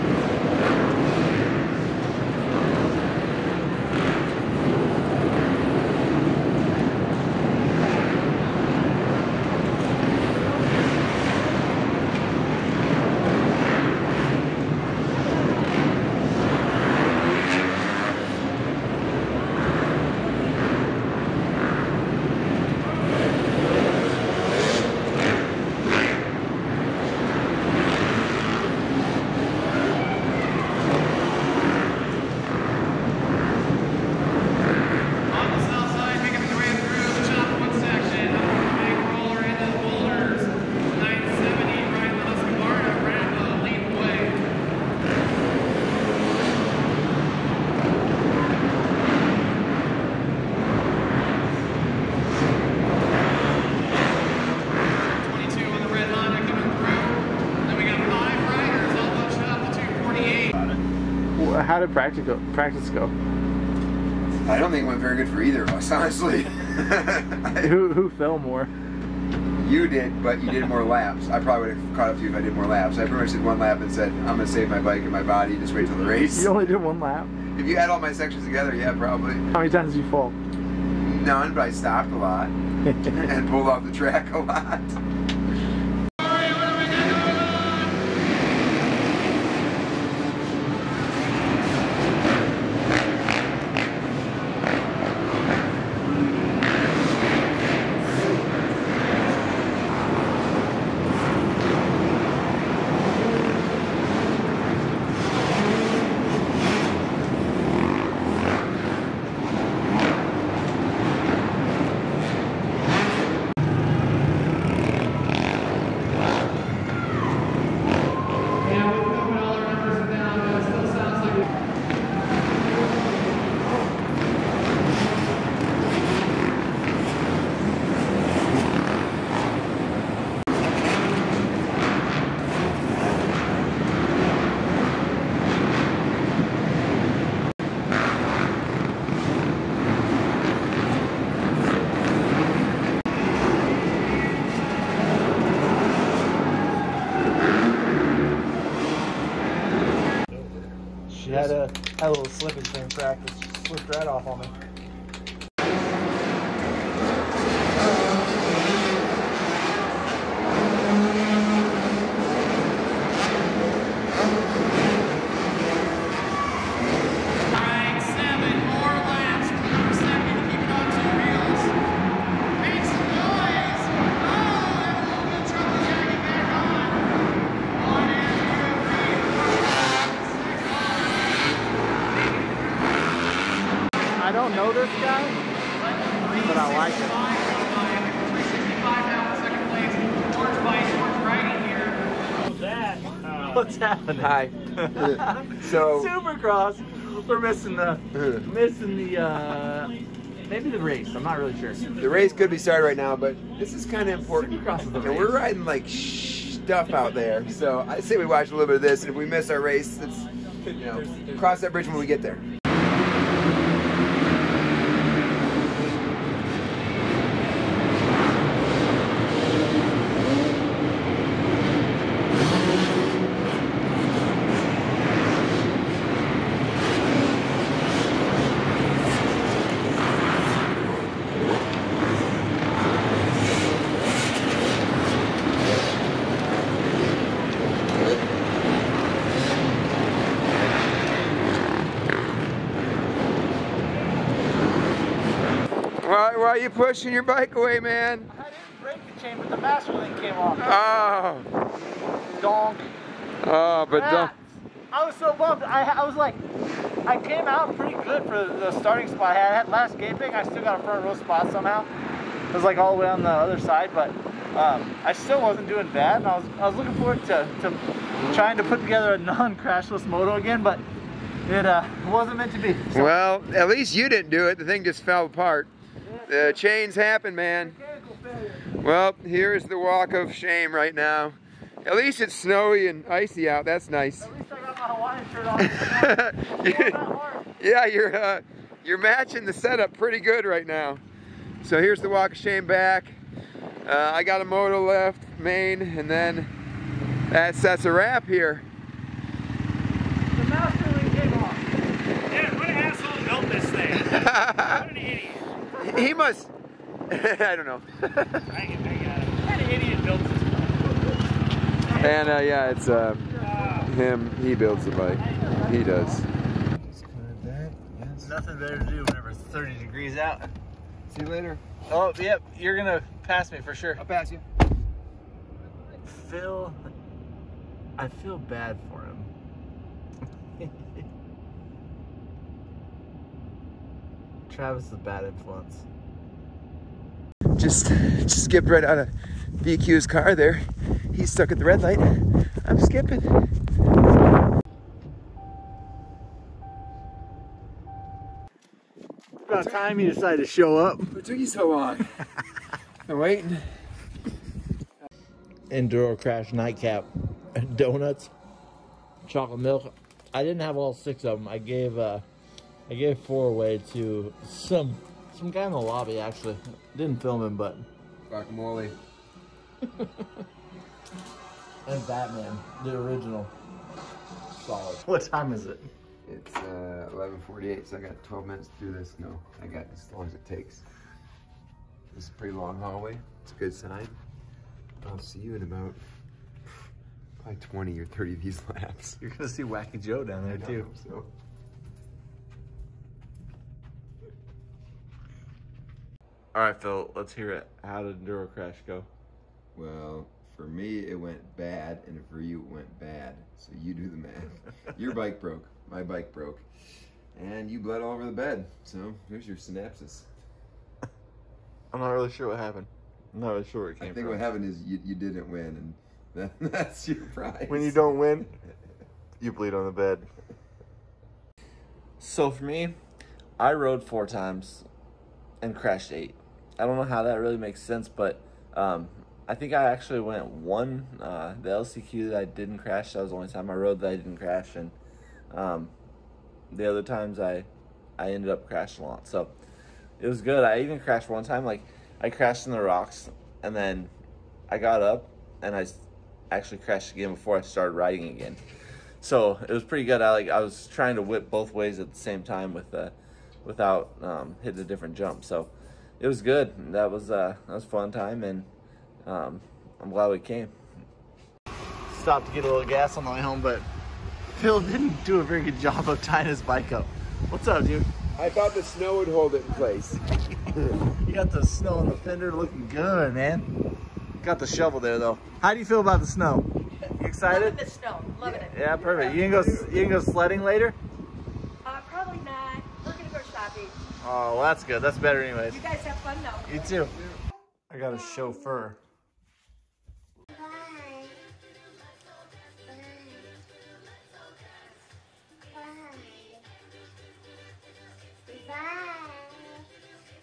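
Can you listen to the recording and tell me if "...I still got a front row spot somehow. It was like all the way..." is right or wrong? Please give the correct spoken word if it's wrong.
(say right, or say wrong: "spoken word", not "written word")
right.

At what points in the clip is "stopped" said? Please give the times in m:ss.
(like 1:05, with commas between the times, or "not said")
1:21, 7:42.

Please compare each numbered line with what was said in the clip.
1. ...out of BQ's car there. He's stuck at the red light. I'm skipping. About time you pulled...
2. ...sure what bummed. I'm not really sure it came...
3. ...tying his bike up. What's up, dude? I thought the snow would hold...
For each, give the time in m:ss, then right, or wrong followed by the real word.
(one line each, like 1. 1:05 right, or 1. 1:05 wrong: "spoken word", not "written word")
1. 5:38 wrong: "decided", not "pulled"
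2. 6:52 wrong: "happened", not "bummed"
3. 7:46 right.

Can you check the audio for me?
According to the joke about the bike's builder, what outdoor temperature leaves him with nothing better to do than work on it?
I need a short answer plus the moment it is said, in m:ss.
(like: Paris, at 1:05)
30 degrees, at 5:19.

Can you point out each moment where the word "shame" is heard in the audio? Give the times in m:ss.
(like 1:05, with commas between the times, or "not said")
4:40, 4:52.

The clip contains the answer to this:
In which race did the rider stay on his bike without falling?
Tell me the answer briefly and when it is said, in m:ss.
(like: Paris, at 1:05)
LCQ, at 7:11.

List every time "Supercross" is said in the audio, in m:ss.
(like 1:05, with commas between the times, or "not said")
3:16, 3:24.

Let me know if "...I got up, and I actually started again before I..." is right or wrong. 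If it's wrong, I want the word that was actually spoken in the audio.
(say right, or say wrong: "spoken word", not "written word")
wrong: "crashed", not "started".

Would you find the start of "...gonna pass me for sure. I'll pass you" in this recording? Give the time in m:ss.
5:22.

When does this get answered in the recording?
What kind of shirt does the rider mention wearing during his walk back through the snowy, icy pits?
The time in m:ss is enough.
4:45.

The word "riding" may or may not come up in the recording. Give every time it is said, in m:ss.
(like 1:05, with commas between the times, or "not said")
3:25, 7:27.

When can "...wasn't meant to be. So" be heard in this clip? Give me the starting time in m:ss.
4:32.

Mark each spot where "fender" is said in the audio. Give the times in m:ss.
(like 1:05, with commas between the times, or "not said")
7:52.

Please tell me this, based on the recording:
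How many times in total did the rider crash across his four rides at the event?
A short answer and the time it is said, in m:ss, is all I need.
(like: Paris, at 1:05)
8, at 7:06.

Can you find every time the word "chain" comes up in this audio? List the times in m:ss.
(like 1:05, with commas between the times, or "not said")
4:09, 4:36.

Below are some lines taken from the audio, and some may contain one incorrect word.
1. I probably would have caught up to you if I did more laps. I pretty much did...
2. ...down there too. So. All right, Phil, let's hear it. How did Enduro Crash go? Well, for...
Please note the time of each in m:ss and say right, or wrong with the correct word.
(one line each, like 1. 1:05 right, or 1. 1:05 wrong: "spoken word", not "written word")
1. 1:11 right
2. 6:30 right.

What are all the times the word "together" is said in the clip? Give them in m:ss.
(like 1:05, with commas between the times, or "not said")
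1:18, 4:28.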